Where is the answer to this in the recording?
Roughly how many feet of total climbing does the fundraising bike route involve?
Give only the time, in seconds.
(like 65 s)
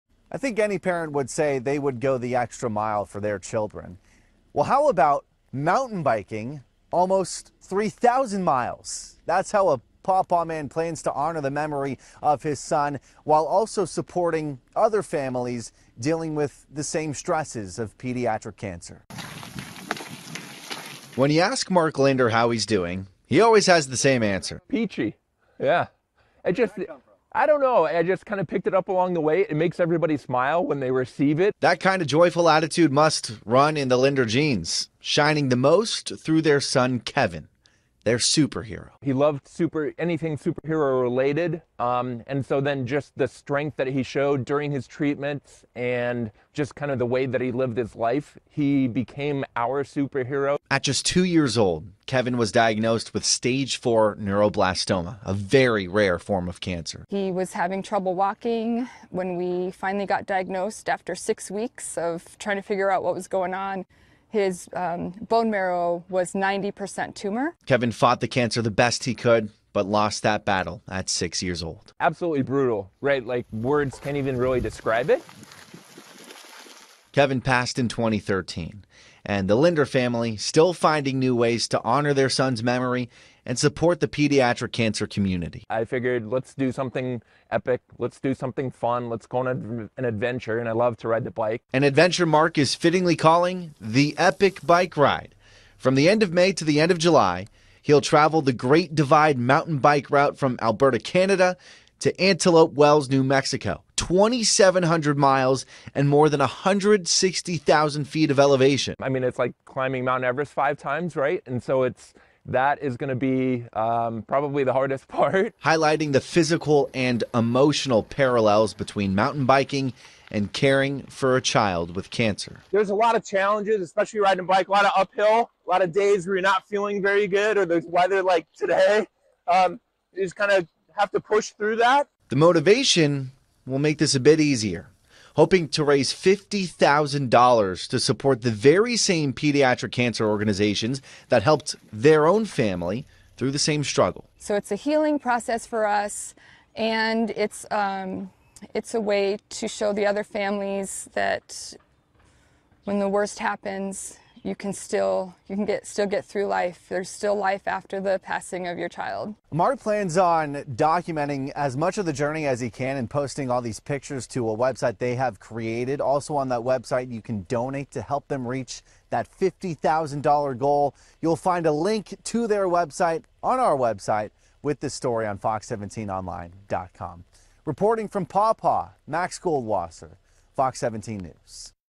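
106 s.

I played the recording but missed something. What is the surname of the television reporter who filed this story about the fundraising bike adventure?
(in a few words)
Goldwasser.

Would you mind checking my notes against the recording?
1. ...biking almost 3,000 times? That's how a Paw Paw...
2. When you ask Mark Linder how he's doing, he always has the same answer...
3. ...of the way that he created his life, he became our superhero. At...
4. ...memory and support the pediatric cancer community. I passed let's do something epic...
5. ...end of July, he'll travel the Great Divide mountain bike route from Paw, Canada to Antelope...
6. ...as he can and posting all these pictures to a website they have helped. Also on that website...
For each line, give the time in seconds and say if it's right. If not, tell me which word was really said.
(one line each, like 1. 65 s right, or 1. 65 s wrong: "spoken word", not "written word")
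1. 6 s wrong: "miles", not "times"
2. 21 s right
3. 46 s wrong: "lived", not "created"
4. 82 s wrong: "figured", not "passed"
5. 96 s wrong: "Alberta", not "Paw"
6. 162 s wrong: "created", not "helped".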